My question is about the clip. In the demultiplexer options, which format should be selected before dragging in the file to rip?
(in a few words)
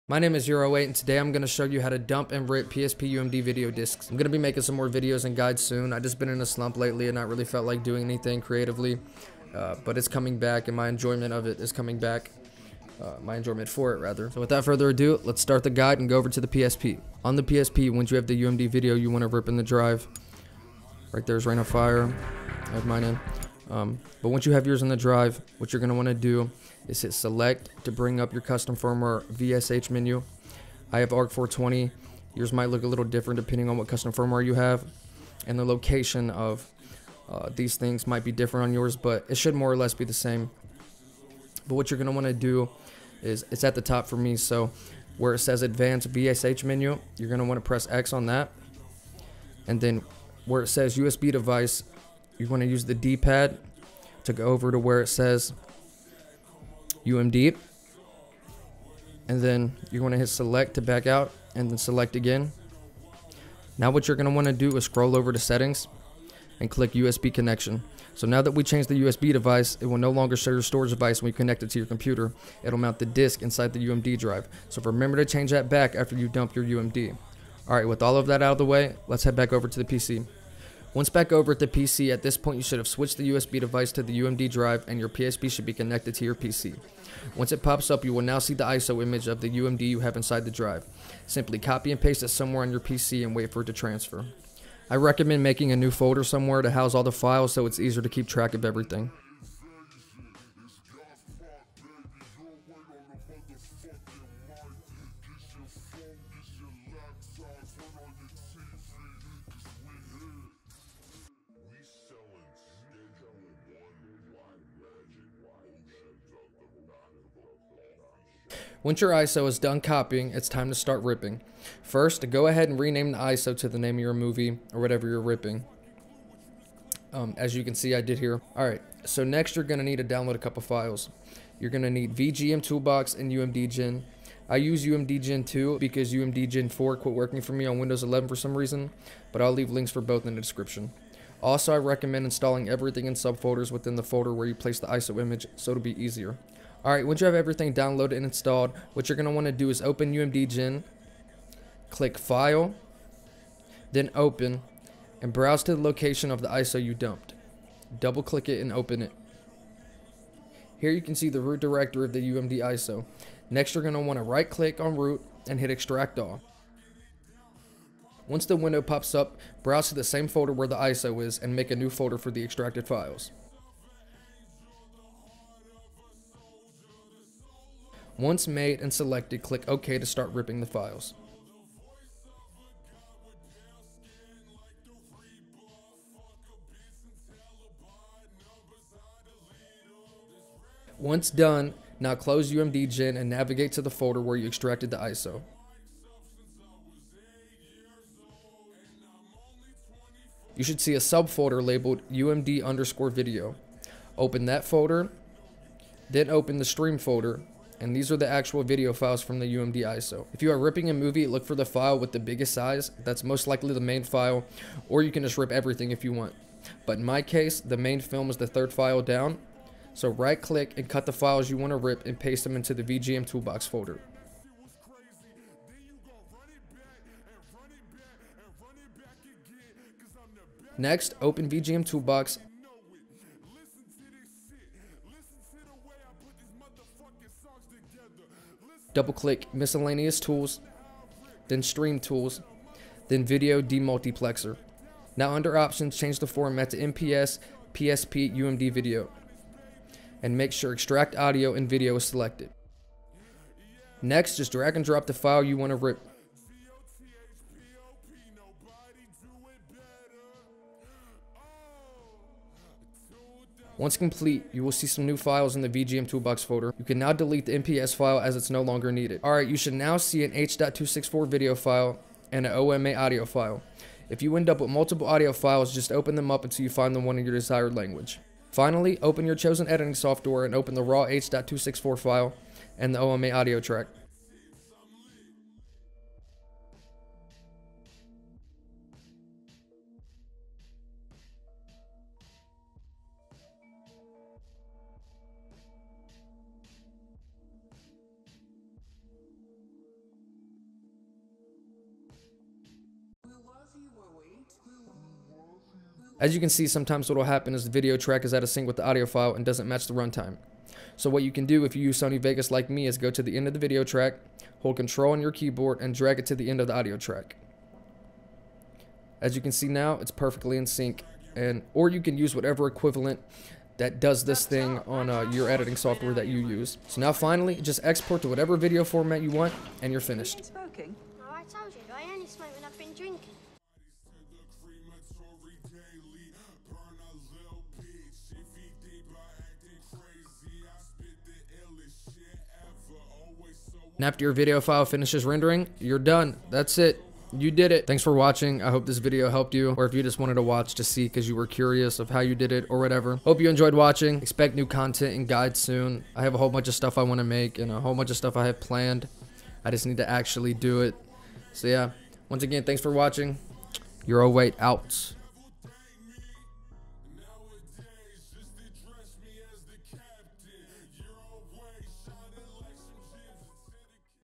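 MPS, PSP, UMD video.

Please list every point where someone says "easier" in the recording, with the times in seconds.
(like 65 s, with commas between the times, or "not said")
97 s, 146 s.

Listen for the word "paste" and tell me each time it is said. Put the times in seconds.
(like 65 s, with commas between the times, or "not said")
92 s, 222 s.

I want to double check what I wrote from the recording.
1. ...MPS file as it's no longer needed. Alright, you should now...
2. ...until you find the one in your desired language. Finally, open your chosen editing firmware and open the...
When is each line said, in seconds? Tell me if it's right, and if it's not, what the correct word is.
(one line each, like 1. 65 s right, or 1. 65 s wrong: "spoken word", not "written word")
1. 267 s right
2. 276 s wrong: "software", not "firmware".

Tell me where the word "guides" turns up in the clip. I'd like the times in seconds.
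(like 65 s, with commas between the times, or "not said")
5 s, 15 s, 355 s.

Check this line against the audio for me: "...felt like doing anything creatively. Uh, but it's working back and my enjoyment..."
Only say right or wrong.
wrong.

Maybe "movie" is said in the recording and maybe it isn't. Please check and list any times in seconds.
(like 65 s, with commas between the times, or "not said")
124 s, 210 s.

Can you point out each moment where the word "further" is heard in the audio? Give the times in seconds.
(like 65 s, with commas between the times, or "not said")
14 s.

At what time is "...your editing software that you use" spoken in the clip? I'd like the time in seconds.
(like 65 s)
325 s.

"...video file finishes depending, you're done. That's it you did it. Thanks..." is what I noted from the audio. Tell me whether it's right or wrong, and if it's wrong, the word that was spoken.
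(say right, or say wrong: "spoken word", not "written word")
wrong: "rendering", not "depending".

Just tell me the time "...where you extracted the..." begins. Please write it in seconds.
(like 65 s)
194 s.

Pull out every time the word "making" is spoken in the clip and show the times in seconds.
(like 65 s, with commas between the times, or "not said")
4 s, 95 s.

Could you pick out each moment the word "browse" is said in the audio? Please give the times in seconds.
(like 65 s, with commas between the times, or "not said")
155 s, 169 s.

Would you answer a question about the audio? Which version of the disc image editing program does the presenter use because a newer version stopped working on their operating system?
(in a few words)
UMD Gen 2.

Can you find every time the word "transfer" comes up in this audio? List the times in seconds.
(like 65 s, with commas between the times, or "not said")
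93 s.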